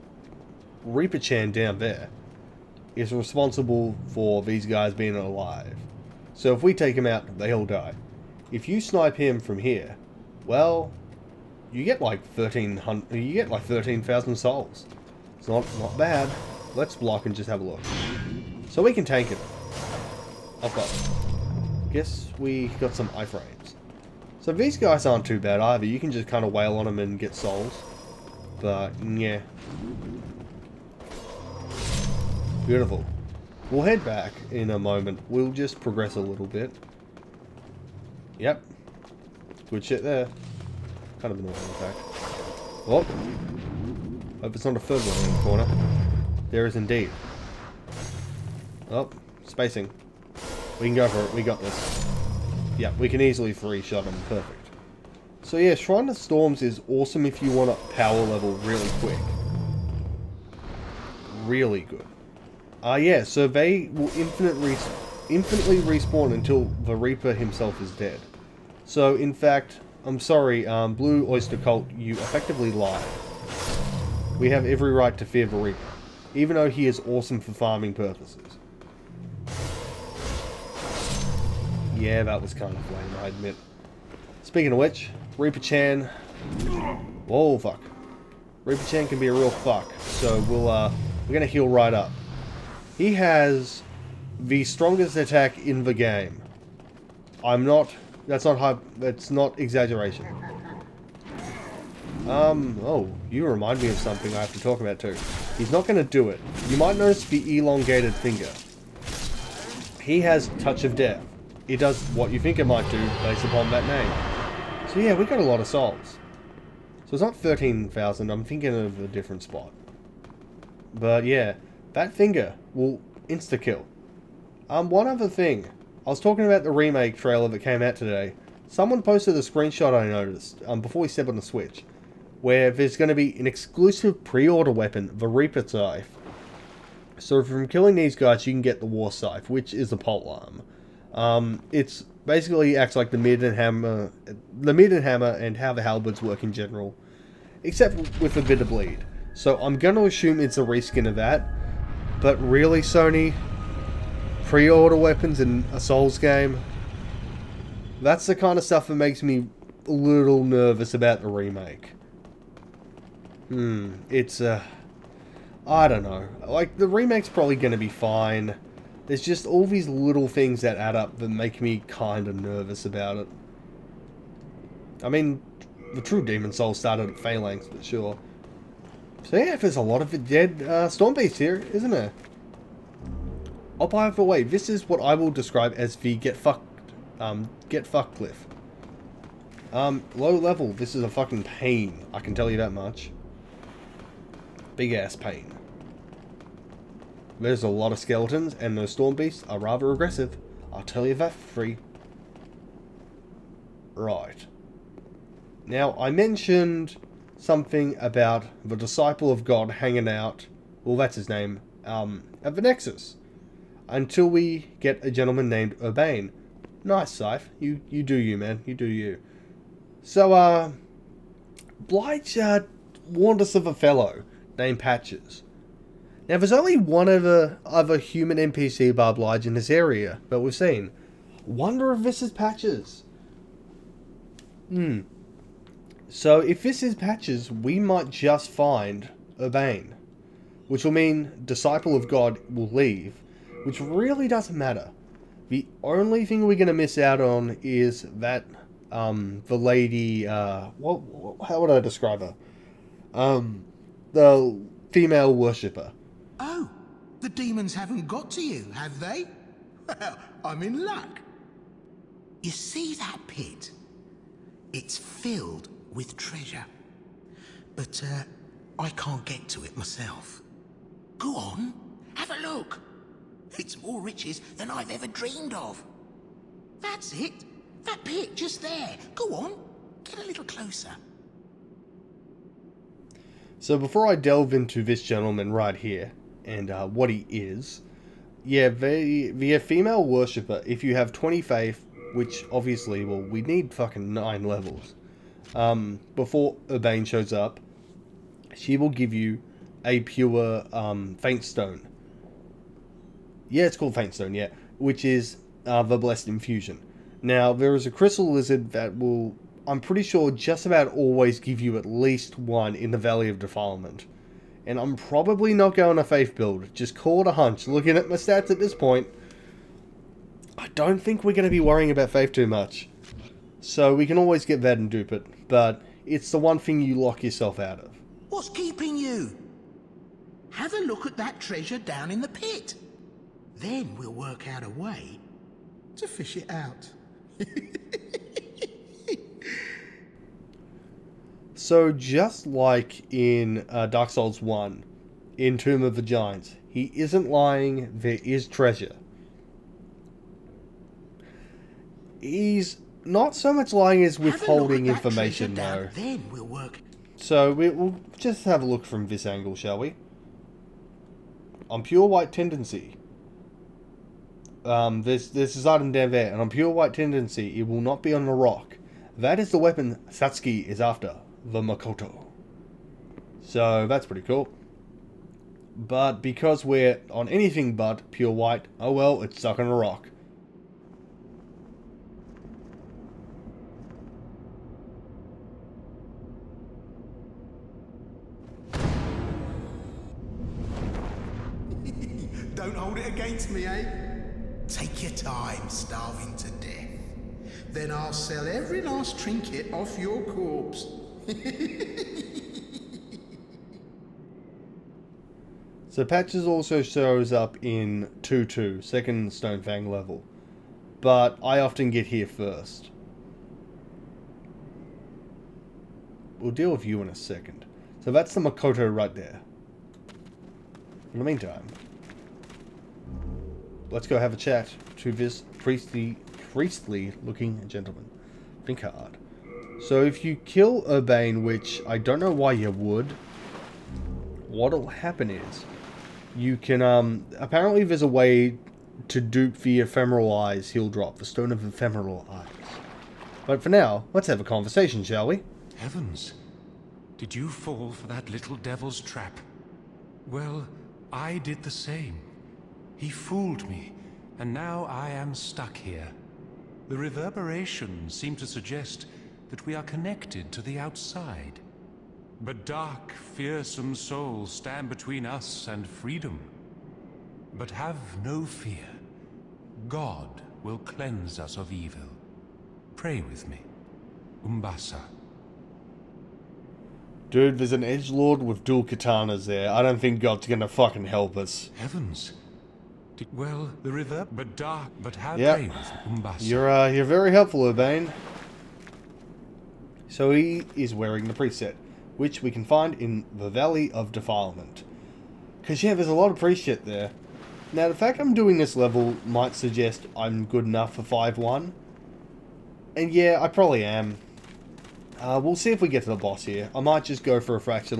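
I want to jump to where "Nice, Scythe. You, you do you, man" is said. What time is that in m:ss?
3:36.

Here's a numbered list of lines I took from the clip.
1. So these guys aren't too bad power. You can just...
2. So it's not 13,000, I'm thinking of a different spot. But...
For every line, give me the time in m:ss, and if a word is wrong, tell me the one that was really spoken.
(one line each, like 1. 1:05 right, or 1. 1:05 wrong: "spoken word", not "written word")
1. 0:24 wrong: "either", not "power"
2. 1:57 right.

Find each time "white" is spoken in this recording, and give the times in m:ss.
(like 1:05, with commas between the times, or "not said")
6:02, 6:06, 6:18.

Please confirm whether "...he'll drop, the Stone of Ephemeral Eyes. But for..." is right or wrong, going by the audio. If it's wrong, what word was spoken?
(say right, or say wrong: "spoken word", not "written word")
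right.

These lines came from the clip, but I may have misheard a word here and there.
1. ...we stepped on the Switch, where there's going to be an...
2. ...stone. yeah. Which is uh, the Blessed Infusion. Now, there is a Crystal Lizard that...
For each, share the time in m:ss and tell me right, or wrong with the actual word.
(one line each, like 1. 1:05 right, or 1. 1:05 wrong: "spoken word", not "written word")
1. 2:11 right
2. 5:04 right.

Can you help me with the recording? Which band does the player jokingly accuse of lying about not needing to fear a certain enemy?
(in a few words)
Blue Oyster Cult.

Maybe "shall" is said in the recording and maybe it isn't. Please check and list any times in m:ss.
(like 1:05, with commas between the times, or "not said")
5:59, 7:25.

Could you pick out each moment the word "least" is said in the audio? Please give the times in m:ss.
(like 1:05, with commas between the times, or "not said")
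5:11.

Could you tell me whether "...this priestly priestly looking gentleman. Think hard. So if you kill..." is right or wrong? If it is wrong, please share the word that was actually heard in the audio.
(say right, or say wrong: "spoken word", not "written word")
right.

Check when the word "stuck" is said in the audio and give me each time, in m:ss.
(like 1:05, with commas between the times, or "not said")
6:19, 7:35.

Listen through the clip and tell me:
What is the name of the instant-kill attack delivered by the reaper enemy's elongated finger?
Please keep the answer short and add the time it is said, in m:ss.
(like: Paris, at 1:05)
Touch of Death, at 1:50.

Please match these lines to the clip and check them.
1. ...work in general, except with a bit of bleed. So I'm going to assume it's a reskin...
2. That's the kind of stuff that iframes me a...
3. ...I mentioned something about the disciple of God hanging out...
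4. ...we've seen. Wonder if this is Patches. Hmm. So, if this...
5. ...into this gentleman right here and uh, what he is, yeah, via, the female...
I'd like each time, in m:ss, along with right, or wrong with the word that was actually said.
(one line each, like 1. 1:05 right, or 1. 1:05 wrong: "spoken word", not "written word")
1. 2:26 right
2. 2:37 wrong: "makes", not "iframes"
3. 3:25 right
4. 3:50 right
5. 4:44 right.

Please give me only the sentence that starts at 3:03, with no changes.
Oh, by the way, this is what I will describe as the get fucked, um, get fucked cliff.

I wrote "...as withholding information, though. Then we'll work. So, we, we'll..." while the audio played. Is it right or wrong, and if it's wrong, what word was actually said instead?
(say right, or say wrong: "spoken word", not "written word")
right.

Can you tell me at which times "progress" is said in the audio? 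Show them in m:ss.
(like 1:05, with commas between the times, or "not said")
0:35.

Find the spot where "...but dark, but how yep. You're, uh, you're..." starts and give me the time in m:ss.
8:04.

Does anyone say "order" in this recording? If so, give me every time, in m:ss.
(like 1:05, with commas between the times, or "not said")
2:14, 2:34.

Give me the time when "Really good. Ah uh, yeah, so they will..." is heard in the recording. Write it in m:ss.
1:01.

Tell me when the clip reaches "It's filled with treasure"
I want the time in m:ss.
4:24.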